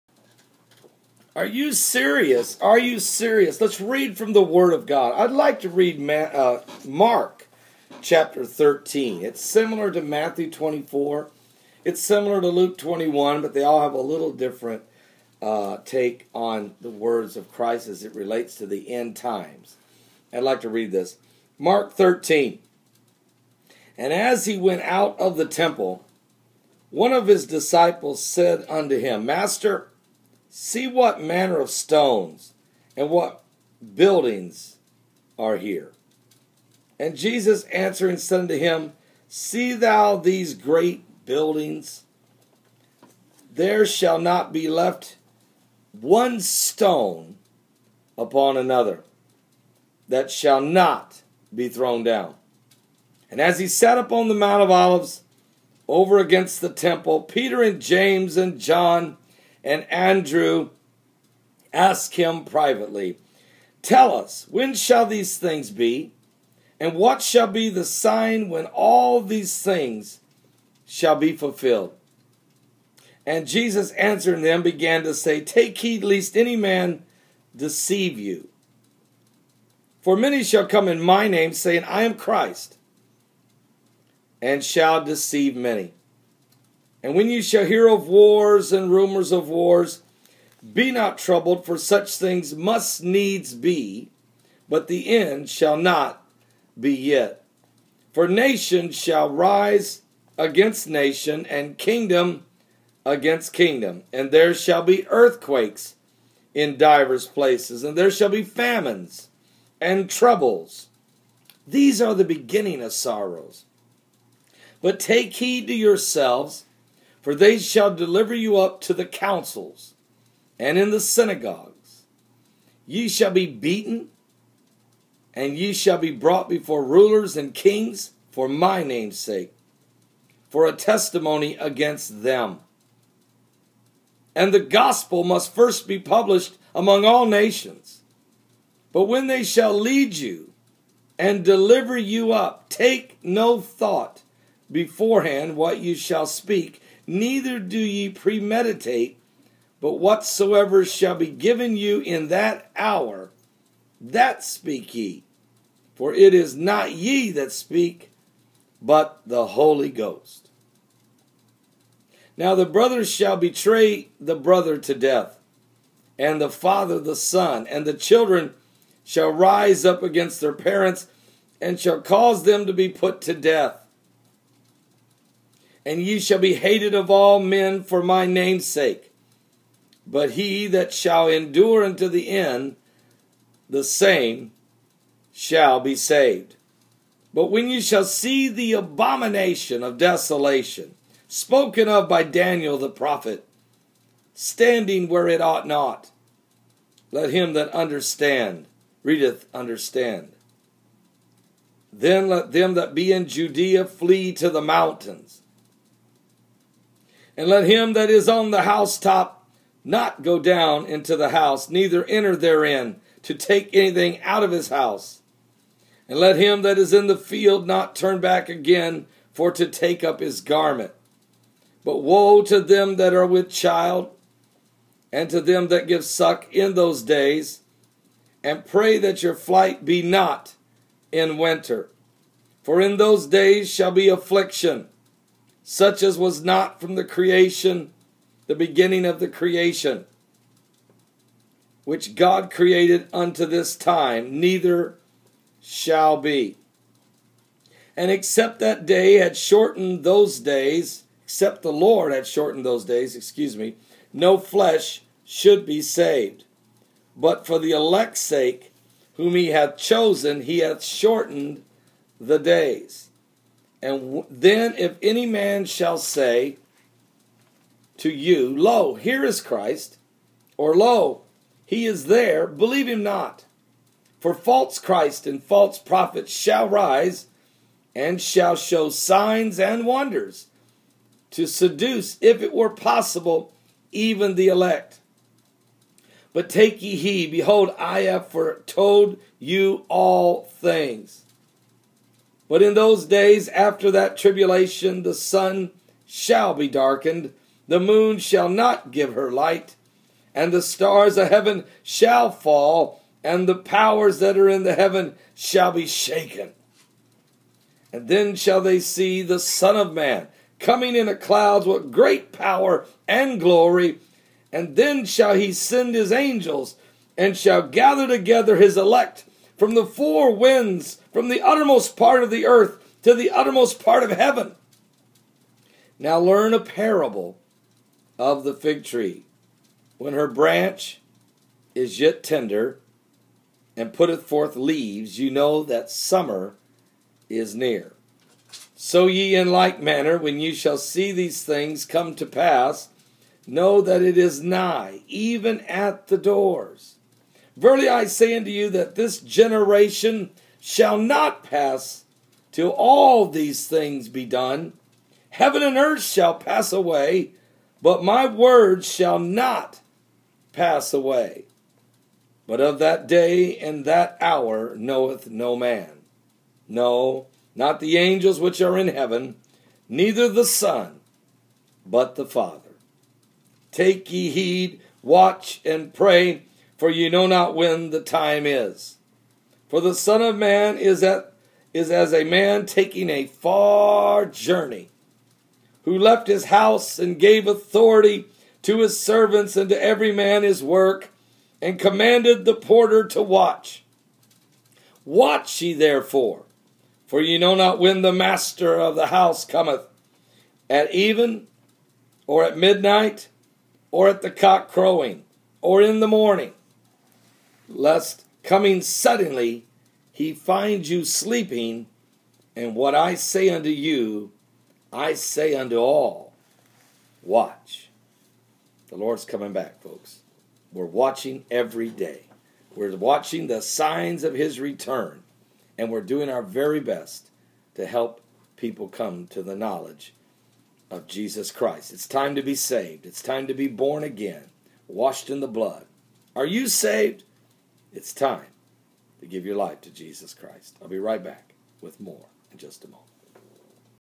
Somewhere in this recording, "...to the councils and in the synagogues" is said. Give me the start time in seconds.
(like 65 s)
118 s.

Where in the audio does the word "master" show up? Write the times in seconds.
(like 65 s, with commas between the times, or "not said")
29 s, 398 s.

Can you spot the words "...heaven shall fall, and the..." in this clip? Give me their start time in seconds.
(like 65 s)
301 s.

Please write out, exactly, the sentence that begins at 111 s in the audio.
These are the beginning of sorrows.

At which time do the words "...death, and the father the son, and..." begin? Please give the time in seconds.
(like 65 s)
164 s.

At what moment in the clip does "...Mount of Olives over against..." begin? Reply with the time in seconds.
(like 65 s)
54 s.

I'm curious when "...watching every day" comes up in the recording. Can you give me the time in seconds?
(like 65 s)
420 s.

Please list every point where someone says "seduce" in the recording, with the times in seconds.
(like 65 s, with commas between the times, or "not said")
281 s.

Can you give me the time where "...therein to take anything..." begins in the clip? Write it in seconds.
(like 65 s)
212 s.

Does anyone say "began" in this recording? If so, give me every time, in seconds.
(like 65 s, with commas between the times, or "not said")
74 s.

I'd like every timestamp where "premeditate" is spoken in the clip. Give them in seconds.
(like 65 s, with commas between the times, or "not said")
148 s.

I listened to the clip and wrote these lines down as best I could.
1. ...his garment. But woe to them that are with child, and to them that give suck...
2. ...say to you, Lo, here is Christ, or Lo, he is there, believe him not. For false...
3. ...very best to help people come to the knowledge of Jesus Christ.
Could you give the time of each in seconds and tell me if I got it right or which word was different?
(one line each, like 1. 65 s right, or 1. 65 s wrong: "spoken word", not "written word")
1. 220 s right
2. 265 s right
3. 426 s right.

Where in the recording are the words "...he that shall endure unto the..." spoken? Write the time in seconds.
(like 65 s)
180 s.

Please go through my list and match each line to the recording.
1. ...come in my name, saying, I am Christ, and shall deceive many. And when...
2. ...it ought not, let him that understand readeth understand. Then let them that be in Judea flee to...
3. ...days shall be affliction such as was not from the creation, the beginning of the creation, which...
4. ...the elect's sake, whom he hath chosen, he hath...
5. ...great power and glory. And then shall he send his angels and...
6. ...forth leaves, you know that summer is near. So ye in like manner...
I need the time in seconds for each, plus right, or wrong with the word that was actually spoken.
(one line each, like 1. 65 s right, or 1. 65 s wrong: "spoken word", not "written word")
1. 80 s right
2. 195 s right
3. 233 s right
4. 257 s right
5. 311 s right
6. 334 s right.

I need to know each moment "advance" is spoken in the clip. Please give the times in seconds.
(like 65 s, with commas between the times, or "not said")
not said.